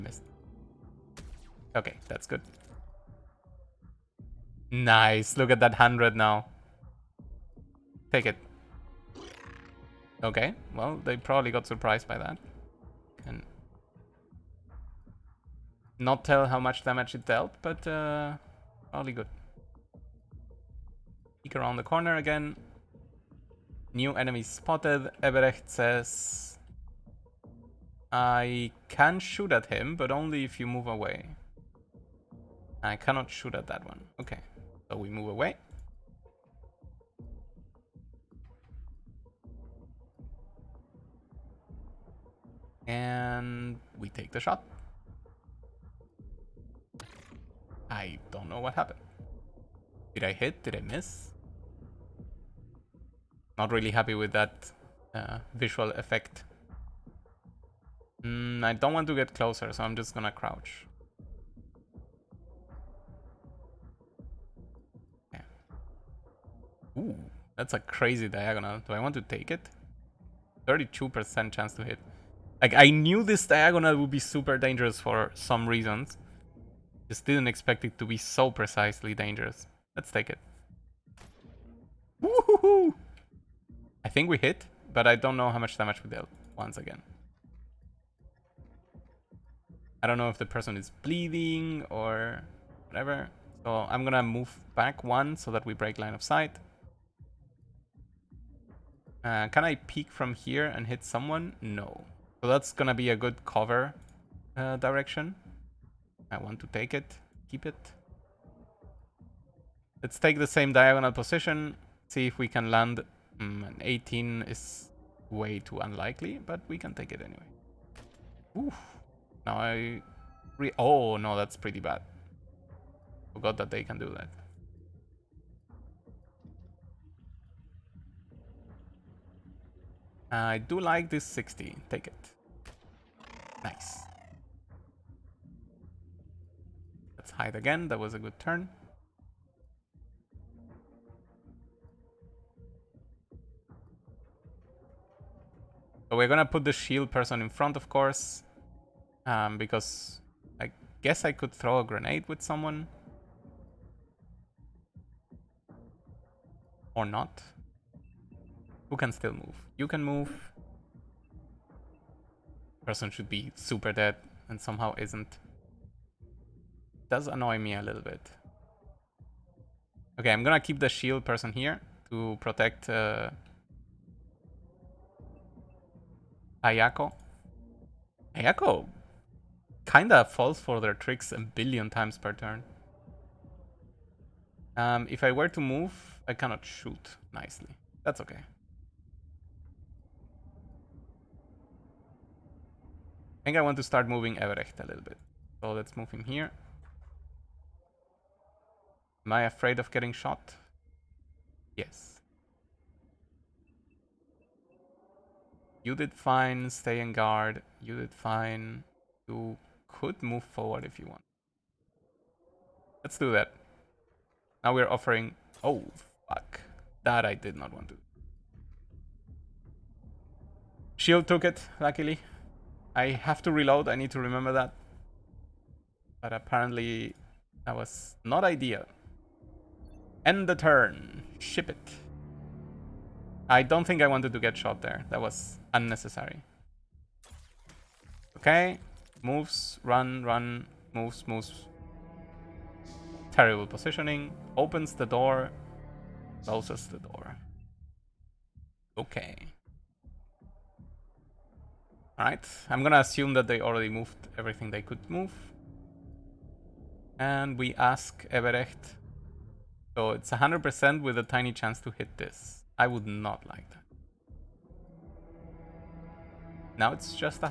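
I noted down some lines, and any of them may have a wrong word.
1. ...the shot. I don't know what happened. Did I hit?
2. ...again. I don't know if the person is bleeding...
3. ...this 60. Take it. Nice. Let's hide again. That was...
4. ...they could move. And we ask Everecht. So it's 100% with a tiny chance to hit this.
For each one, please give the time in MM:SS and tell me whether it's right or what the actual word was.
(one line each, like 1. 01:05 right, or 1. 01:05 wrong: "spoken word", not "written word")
1. 00:44 right
2. 01:26 right
3. 02:11 right
4. 04:14 right.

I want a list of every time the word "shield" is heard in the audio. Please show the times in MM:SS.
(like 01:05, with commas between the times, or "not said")
02:26, 02:50, 03:40.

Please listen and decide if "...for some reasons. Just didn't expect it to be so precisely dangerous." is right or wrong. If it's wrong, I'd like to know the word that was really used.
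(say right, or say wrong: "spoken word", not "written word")
right.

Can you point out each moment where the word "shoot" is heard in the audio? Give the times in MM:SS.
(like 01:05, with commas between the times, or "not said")
00:29, 00:33, 03:06.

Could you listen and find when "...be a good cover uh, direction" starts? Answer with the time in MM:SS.
01:42.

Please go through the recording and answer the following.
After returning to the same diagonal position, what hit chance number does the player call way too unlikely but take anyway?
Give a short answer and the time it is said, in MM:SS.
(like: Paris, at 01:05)
18, at 01:53.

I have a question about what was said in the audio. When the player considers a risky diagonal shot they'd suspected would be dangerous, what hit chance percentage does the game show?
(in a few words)
32%.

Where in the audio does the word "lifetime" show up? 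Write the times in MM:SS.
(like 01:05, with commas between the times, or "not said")
not said.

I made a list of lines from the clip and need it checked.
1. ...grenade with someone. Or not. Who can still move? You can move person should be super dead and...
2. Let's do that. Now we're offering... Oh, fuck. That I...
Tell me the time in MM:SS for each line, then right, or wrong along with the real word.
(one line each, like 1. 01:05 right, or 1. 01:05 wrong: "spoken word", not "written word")
1. 02:31 right
2. 03:33 right.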